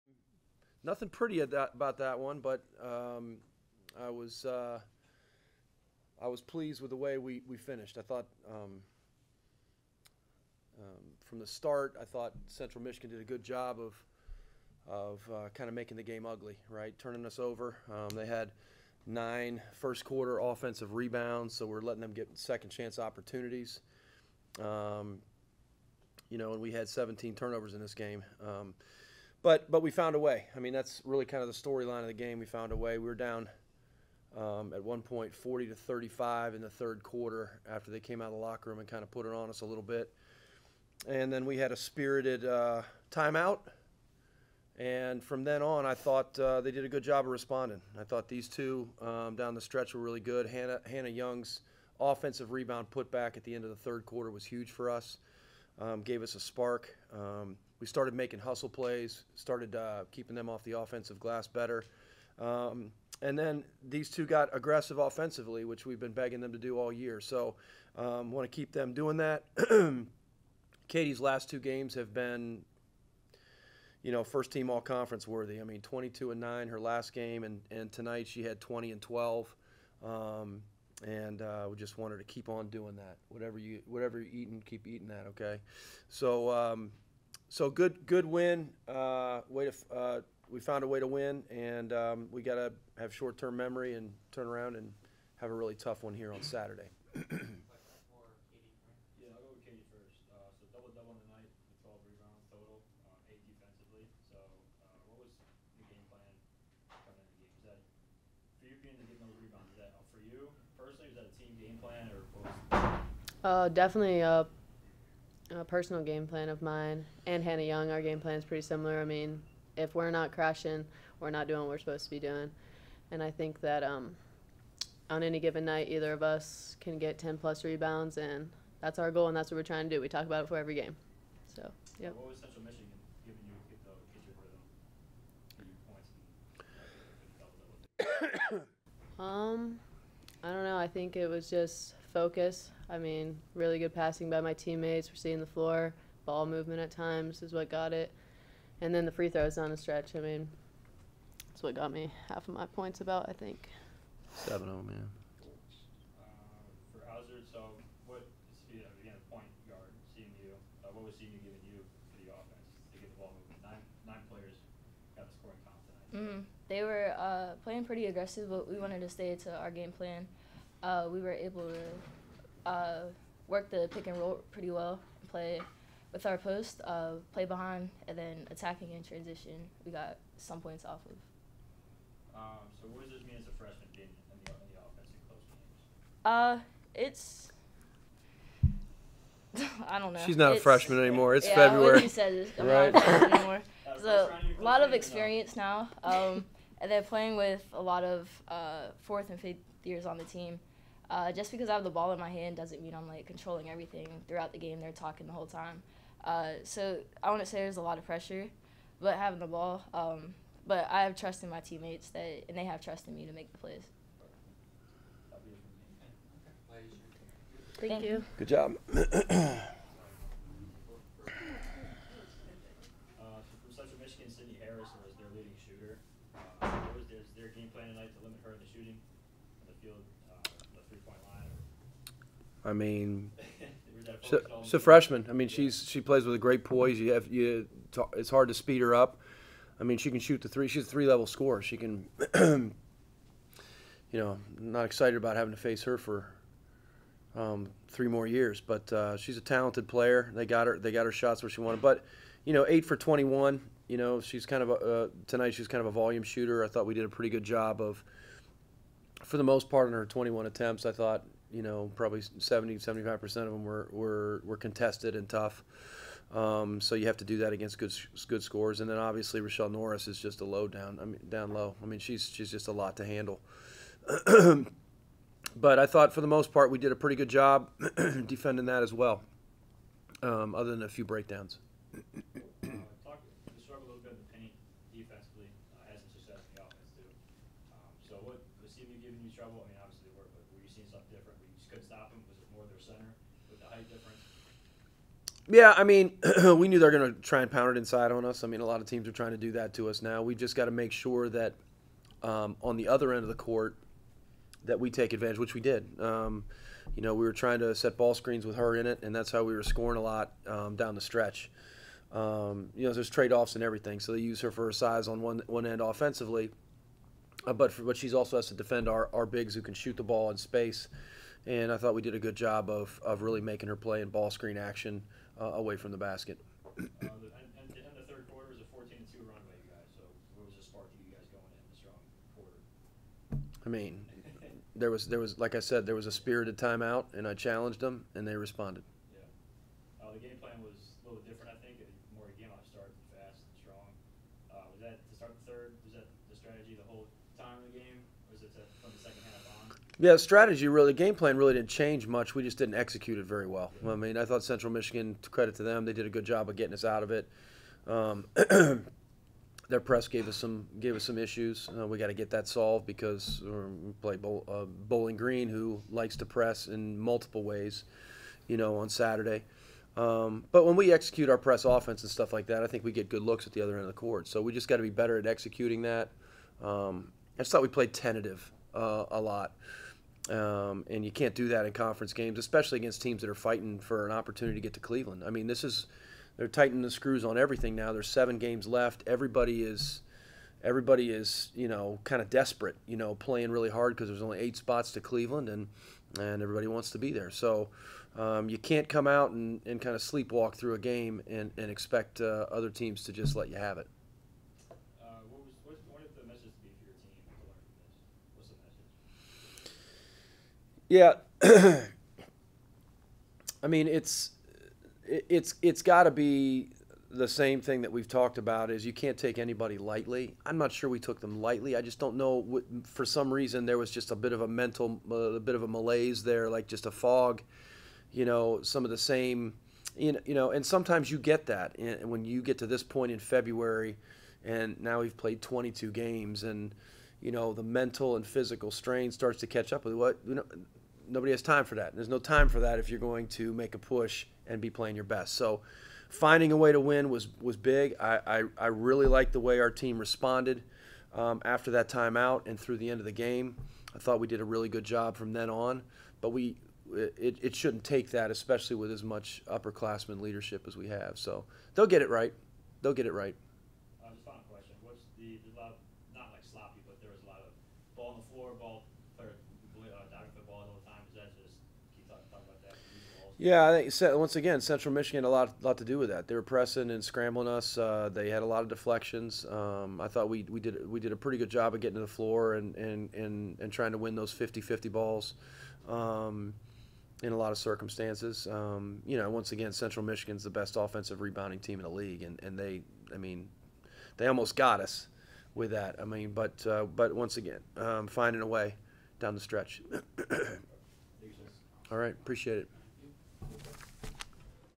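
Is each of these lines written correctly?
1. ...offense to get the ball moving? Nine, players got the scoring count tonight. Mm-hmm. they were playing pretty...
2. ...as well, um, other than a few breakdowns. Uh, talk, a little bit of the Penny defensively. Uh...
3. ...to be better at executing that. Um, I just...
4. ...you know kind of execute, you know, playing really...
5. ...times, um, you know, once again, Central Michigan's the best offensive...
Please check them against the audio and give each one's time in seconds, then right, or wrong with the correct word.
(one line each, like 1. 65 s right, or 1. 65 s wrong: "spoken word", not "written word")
1. 162 s right
2. 278 s right
3. 374 s right
4. 391 s wrong: "desperate", not "execute"
5. 487 s wrong: "circumstances", not "times".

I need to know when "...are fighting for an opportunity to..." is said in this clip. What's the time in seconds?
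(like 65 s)
383 s.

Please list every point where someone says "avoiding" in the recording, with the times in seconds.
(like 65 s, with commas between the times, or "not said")
not said.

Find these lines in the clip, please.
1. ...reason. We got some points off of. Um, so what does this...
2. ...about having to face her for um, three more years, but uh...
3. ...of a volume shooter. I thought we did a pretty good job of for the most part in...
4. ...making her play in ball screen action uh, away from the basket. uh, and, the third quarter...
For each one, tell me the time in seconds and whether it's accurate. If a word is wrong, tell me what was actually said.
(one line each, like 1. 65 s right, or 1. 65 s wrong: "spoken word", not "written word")
1. 179 s wrong: "transition", not "reason"
2. 245 s right
3. 255 s right
4. 323 s right.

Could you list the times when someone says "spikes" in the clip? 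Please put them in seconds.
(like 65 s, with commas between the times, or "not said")
not said.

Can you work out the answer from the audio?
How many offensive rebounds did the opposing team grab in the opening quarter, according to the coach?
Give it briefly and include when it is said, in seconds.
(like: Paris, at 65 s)
9, at 19 s.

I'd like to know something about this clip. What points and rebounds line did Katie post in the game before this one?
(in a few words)
22 and 9.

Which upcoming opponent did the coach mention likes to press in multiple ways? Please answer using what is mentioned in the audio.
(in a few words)
Bowling Green.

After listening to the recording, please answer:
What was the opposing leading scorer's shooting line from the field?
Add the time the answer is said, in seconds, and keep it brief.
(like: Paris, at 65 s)
8 for 21, at 252 s.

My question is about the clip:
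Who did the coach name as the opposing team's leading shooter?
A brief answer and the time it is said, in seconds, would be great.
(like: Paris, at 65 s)
Sydney Harrison, at 224 s.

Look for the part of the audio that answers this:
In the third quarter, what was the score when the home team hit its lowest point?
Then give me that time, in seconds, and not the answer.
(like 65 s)
35 s.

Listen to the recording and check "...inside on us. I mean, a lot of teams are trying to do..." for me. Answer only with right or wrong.
right.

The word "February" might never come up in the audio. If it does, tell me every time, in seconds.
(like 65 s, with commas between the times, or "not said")
191 s, 433 s.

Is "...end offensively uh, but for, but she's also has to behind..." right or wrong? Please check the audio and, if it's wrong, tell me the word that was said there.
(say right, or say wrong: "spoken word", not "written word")
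wrong: "defend", not "behind".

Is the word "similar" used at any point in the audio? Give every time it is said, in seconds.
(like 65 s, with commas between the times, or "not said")
118 s.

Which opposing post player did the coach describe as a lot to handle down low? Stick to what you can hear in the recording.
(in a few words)
Rochelle Norris.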